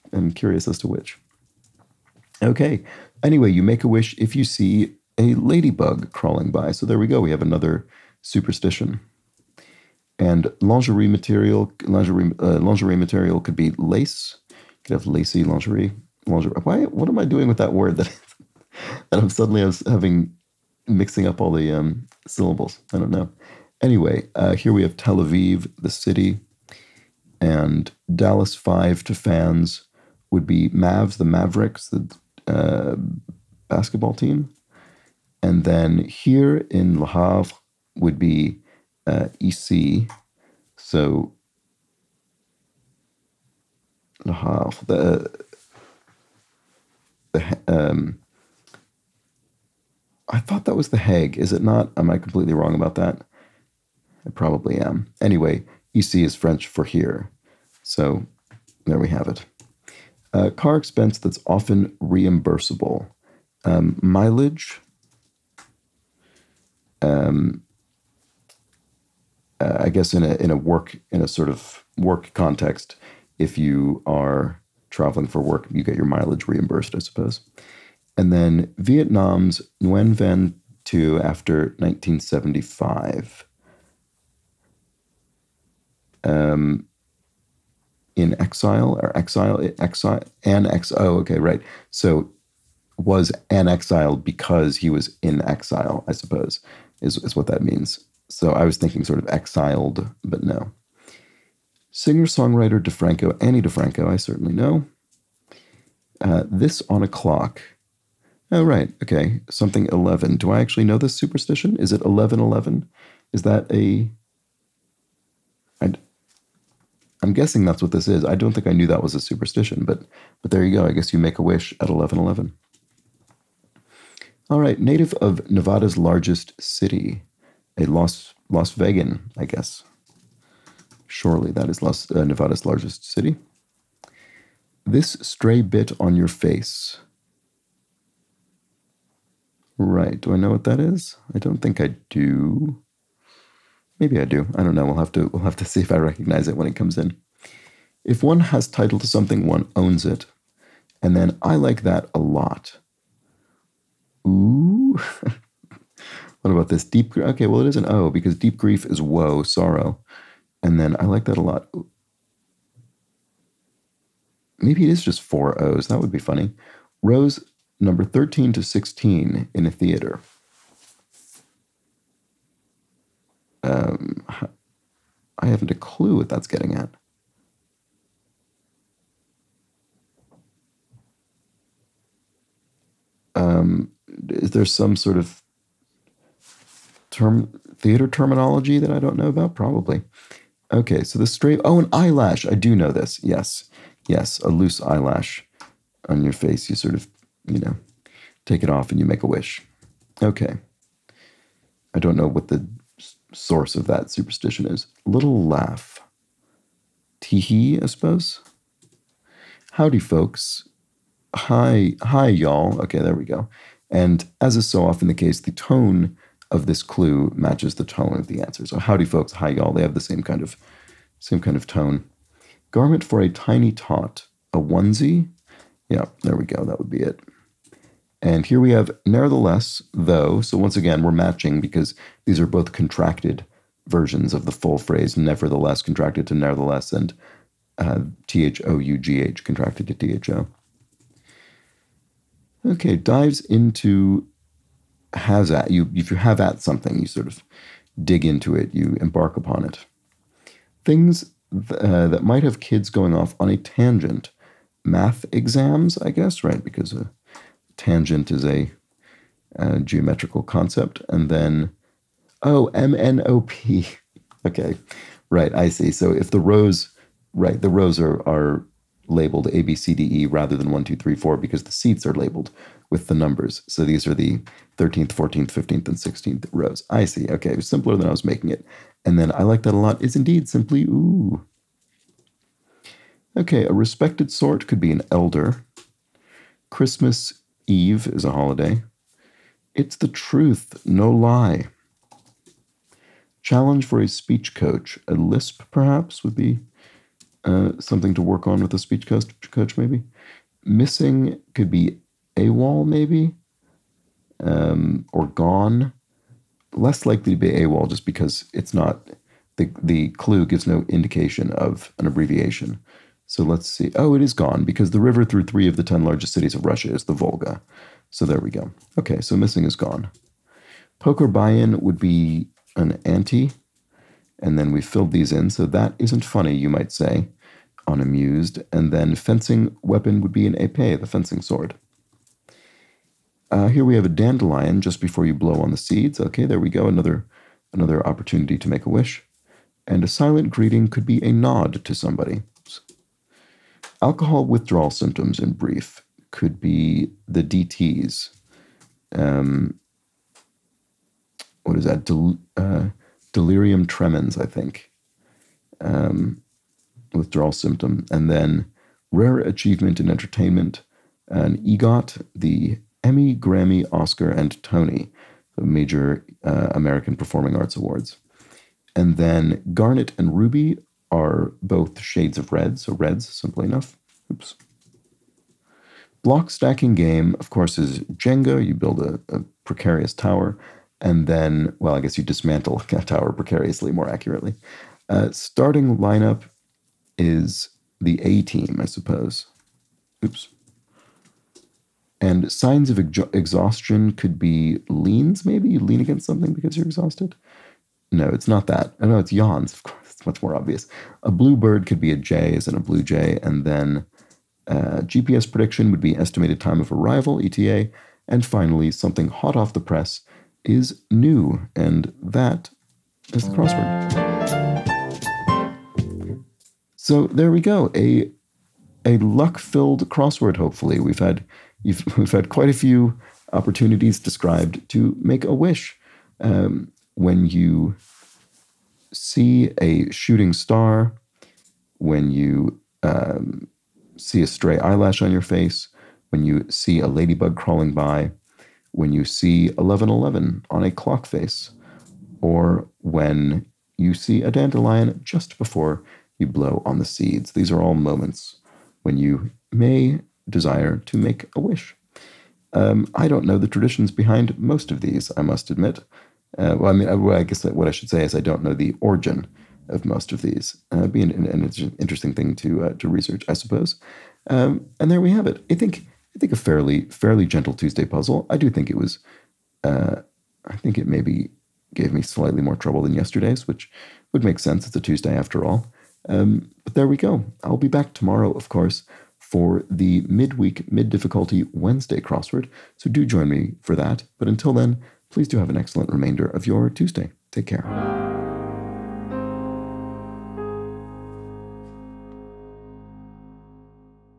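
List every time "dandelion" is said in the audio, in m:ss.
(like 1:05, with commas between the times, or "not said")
5:34, 7:24.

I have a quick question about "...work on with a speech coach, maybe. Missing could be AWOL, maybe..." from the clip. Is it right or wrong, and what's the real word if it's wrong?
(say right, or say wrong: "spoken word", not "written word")
right.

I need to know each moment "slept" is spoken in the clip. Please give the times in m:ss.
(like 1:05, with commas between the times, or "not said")
not said.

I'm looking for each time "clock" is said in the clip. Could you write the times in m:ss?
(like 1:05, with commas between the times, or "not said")
1:47, 7:20.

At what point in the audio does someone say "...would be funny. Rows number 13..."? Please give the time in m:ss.
2:45.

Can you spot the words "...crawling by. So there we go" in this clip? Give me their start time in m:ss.
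0:06.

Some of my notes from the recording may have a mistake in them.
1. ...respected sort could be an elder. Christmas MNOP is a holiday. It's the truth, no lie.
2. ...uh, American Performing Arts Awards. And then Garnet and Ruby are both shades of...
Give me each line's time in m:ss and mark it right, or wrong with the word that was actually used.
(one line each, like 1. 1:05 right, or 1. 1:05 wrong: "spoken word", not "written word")
1. 4:43 wrong: "Eve", not "MNOP"
2. 6:06 right.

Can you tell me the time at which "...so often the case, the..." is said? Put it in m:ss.
3:34.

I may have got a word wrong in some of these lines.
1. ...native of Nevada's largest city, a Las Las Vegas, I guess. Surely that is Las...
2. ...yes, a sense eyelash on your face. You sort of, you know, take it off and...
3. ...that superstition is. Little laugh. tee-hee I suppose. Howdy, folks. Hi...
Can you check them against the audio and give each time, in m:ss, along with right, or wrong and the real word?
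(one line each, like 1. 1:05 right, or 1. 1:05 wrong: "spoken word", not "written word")
1. 2:04 right
2. 3:14 wrong: "loose", not "sense"
3. 3:23 right.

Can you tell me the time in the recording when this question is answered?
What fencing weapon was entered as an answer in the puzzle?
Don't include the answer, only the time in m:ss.
5:30.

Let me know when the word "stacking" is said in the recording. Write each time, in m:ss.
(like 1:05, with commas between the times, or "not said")
6:16.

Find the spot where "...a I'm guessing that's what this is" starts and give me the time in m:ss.
1:53.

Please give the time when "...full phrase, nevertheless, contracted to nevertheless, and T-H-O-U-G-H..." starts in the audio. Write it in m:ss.
3:54.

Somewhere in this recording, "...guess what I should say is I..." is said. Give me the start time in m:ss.
7:37.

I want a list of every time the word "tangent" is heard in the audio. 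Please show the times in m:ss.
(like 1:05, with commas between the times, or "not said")
4:13, 4:17.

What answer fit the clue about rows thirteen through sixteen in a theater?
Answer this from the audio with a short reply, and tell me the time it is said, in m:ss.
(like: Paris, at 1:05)
MNOP, at 4:22.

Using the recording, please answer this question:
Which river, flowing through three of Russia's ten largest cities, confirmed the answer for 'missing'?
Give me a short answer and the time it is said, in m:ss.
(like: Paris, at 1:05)
Volga, at 5:17.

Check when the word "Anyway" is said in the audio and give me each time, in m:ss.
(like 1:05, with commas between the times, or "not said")
0:03, 0:23, 0:55.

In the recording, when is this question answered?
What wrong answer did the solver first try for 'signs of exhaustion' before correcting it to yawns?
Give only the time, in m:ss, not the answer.
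6:34.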